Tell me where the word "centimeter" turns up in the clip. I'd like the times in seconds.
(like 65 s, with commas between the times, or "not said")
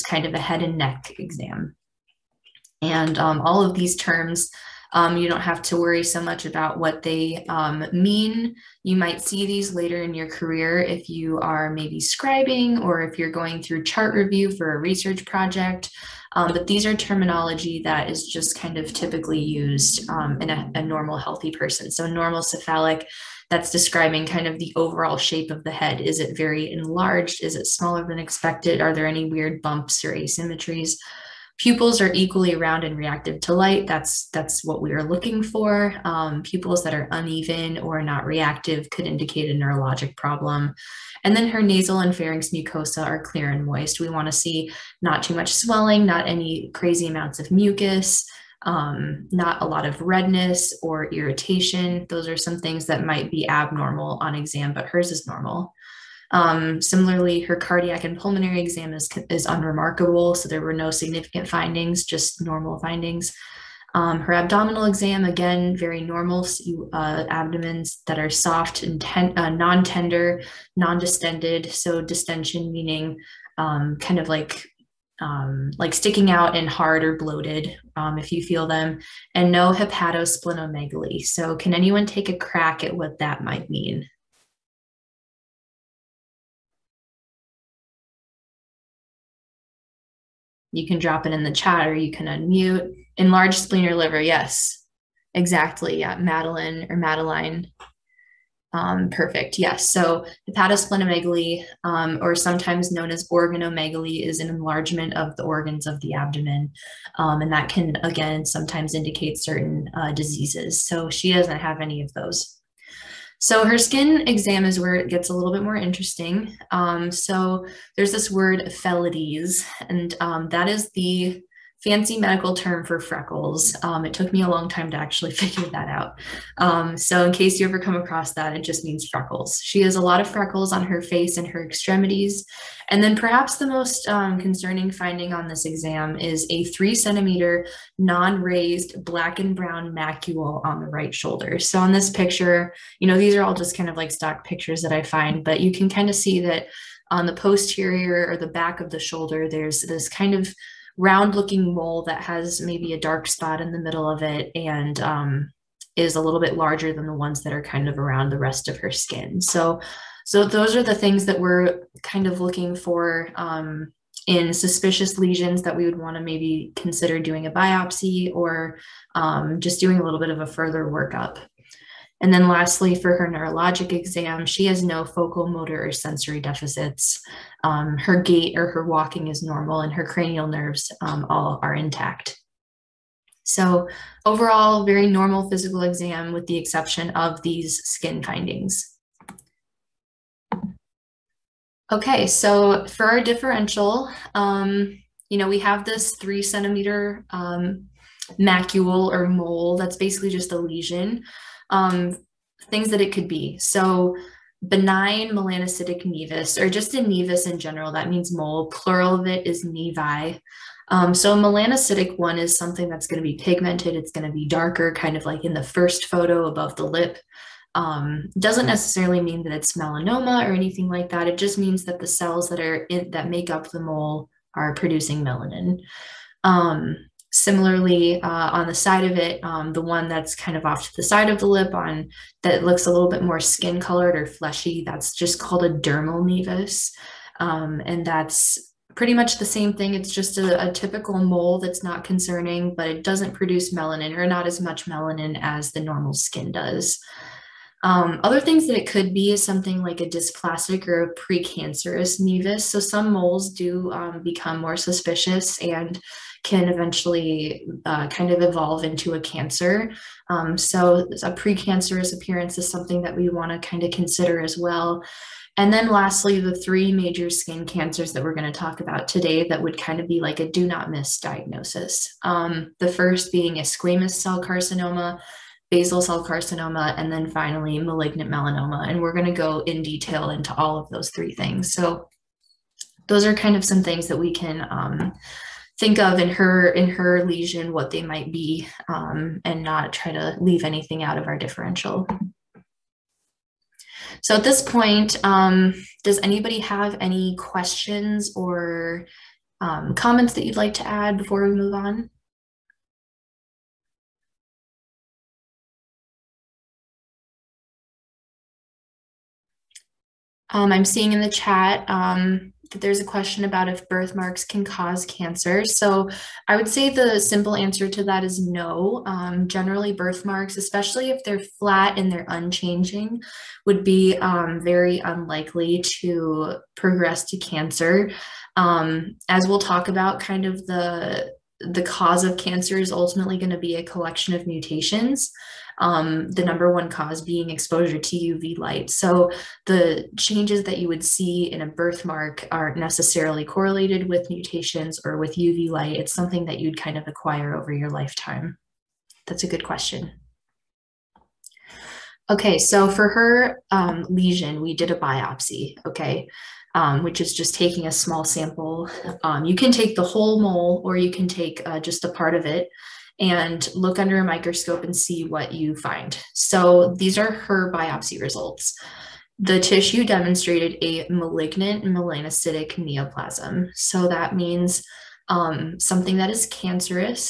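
136 s, 196 s.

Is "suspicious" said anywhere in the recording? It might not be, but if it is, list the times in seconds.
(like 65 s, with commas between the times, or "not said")
164 s, 254 s.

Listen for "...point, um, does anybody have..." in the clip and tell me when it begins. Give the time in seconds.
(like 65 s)
294 s.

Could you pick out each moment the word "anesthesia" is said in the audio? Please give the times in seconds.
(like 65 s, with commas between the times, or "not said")
not said.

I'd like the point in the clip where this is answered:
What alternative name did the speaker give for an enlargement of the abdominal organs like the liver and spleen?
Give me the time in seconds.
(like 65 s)
103 s.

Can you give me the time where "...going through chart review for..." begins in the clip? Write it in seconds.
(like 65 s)
13 s.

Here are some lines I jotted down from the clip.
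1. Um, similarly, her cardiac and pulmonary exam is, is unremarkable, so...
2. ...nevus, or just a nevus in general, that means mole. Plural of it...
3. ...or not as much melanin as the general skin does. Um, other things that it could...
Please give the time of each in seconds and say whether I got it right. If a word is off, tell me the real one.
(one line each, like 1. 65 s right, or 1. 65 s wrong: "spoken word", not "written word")
1. 56 s right
2. 206 s right
3. 244 s wrong: "normal", not "general".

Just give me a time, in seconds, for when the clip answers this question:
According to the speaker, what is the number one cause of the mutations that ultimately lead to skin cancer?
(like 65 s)
337 s.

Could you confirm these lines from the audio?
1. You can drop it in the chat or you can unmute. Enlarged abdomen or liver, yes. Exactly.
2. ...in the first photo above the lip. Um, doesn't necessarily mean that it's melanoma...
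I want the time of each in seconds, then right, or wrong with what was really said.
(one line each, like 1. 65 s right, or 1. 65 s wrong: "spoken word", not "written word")
1. 90 s wrong: "spleen", not "abdomen"
2. 215 s right.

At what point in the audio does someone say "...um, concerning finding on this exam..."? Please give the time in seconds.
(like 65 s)
134 s.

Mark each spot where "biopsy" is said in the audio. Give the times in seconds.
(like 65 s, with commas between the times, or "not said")
167 s, 354 s, 367 s.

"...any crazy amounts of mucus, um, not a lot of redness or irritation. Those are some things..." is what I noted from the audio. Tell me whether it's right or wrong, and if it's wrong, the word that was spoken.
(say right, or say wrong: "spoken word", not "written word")
right.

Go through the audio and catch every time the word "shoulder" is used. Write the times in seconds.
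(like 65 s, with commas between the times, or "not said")
141 s, 148 s.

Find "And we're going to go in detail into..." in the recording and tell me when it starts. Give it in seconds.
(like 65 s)
278 s.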